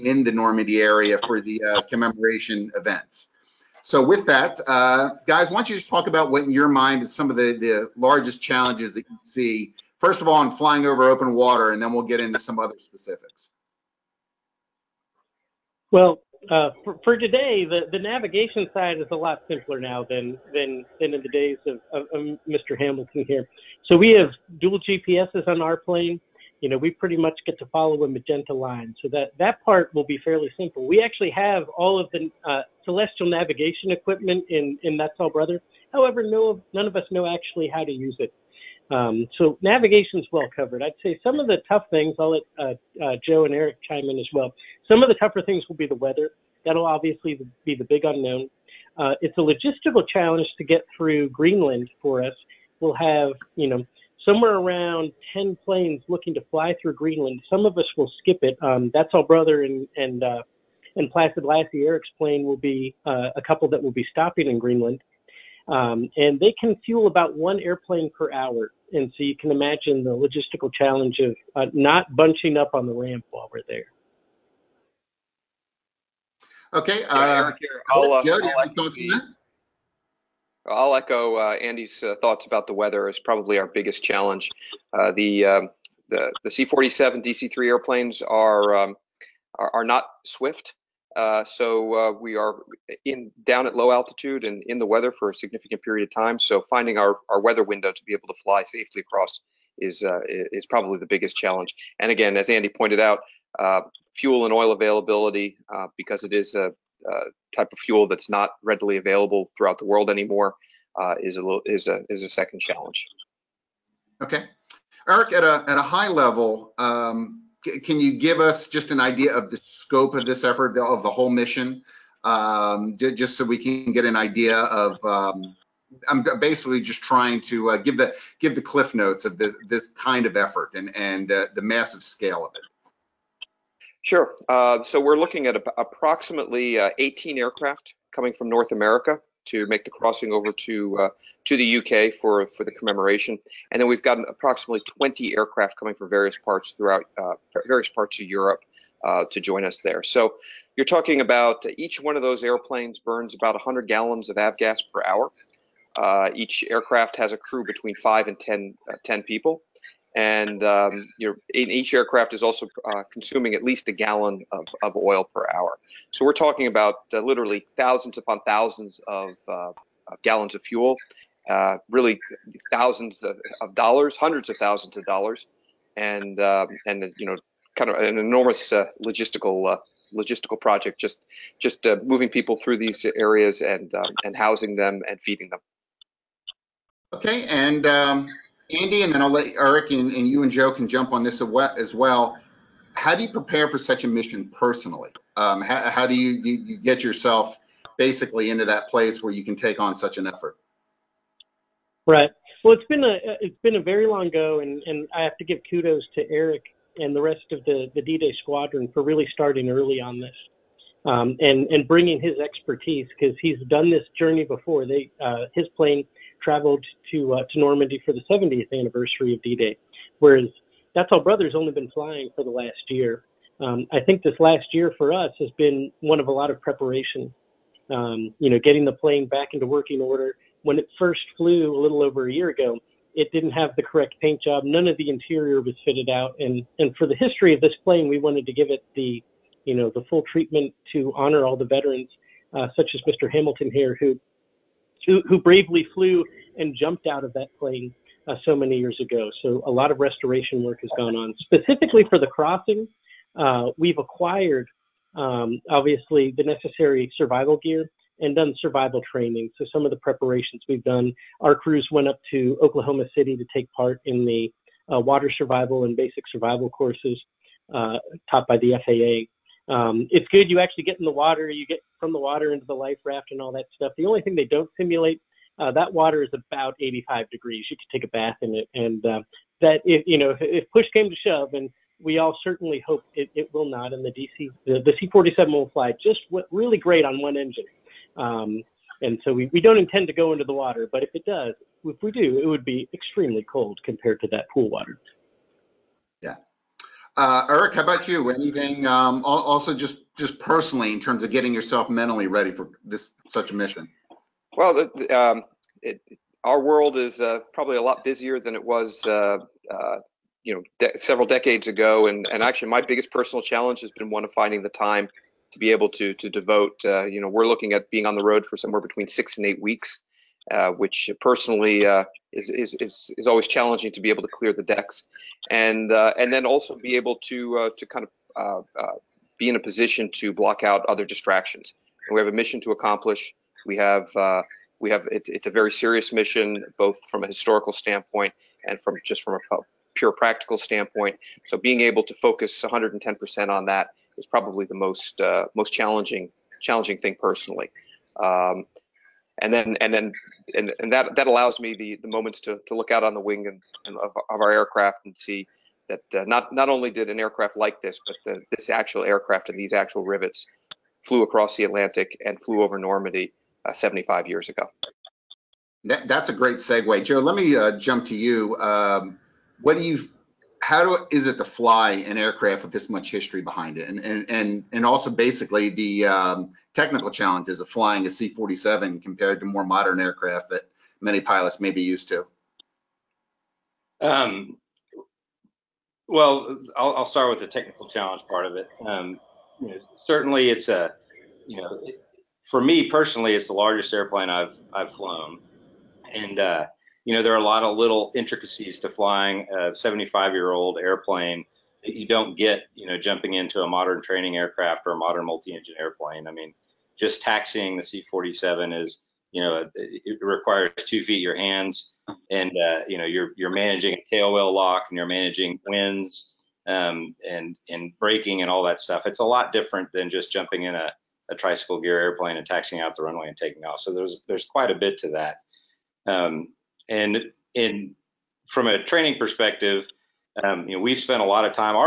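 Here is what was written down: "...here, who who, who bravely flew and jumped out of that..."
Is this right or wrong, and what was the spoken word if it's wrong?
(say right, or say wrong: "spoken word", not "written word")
right.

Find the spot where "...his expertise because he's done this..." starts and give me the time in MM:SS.
03:32.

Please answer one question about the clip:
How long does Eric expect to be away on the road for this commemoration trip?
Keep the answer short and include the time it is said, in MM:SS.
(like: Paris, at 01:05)
6 to 8 weeks, at 05:19.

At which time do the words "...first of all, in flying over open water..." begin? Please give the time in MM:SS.
00:09.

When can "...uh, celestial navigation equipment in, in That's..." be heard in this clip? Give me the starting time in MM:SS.
00:32.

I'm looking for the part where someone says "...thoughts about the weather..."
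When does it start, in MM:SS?
01:22.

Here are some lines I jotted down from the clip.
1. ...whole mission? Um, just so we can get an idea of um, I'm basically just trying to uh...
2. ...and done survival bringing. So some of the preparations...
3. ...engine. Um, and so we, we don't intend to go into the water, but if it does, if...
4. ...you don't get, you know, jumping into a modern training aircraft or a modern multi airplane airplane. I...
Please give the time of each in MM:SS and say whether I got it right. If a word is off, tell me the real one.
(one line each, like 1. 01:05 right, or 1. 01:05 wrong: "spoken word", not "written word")
1. 02:01 right
2. 04:18 wrong: "training", not "bringing"
3. 04:47 right
4. 06:41 wrong: "engine", not "airplane".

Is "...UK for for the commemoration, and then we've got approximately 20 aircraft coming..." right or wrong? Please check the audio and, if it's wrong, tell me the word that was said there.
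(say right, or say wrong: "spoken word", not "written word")
right.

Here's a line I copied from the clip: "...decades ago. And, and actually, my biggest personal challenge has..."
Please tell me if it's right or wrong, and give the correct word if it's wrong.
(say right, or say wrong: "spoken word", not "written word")
right.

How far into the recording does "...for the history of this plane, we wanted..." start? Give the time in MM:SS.
03:56.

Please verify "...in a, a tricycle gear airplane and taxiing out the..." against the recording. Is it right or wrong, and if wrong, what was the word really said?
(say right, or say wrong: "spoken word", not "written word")
right.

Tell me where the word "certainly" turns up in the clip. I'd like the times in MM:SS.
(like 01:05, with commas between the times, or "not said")
04:42, 06:29.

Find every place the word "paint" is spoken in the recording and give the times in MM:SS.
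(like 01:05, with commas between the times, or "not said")
03:54.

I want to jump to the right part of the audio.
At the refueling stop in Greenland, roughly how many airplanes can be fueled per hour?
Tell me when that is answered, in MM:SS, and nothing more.
01:07.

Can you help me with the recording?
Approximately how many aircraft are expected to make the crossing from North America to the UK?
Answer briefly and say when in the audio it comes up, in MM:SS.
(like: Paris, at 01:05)
18, at 02:16.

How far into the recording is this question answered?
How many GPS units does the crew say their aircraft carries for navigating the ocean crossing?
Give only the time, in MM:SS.
00:24.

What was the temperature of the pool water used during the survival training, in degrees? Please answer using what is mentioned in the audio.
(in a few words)
85.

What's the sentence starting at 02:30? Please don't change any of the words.
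So you're talking about each one of those airplanes burns about 100 gallons of avgas per hour.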